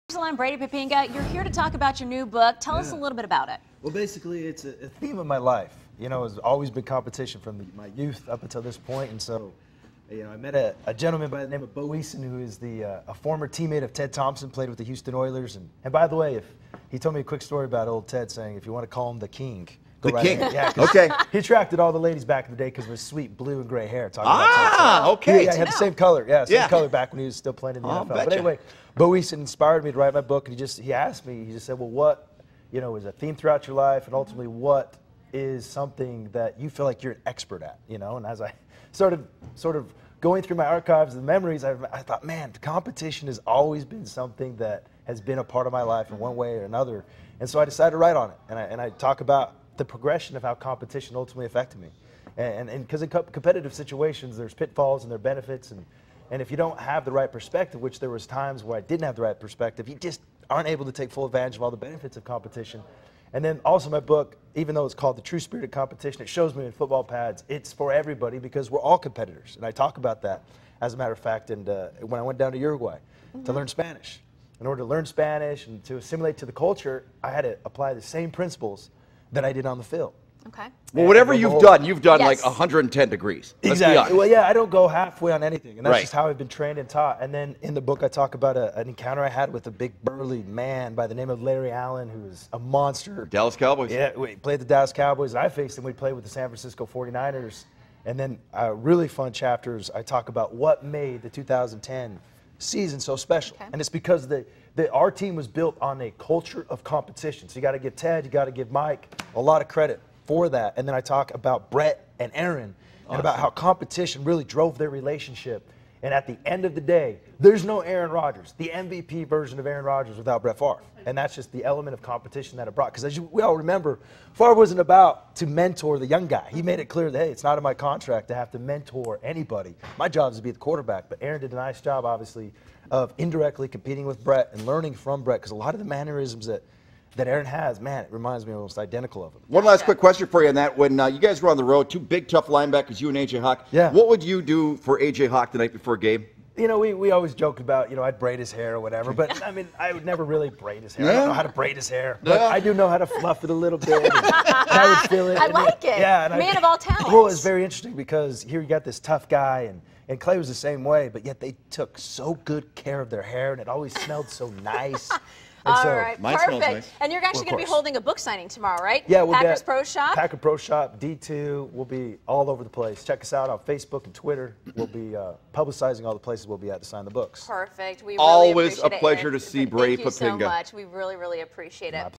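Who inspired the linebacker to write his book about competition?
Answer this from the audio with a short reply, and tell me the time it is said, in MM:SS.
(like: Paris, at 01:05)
Bo Eason, at 00:11.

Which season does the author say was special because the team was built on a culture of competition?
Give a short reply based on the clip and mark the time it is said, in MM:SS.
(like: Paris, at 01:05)
2010, at 01:41.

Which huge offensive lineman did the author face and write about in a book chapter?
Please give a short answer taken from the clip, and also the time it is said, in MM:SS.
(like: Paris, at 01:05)
Larry Allen, at 01:31.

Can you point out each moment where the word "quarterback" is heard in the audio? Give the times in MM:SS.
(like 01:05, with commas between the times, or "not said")
02:10.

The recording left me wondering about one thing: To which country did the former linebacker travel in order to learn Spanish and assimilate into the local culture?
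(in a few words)
Uruguay.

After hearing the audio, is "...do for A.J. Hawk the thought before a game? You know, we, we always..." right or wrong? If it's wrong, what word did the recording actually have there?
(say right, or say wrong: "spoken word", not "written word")
wrong: "night", not "thought".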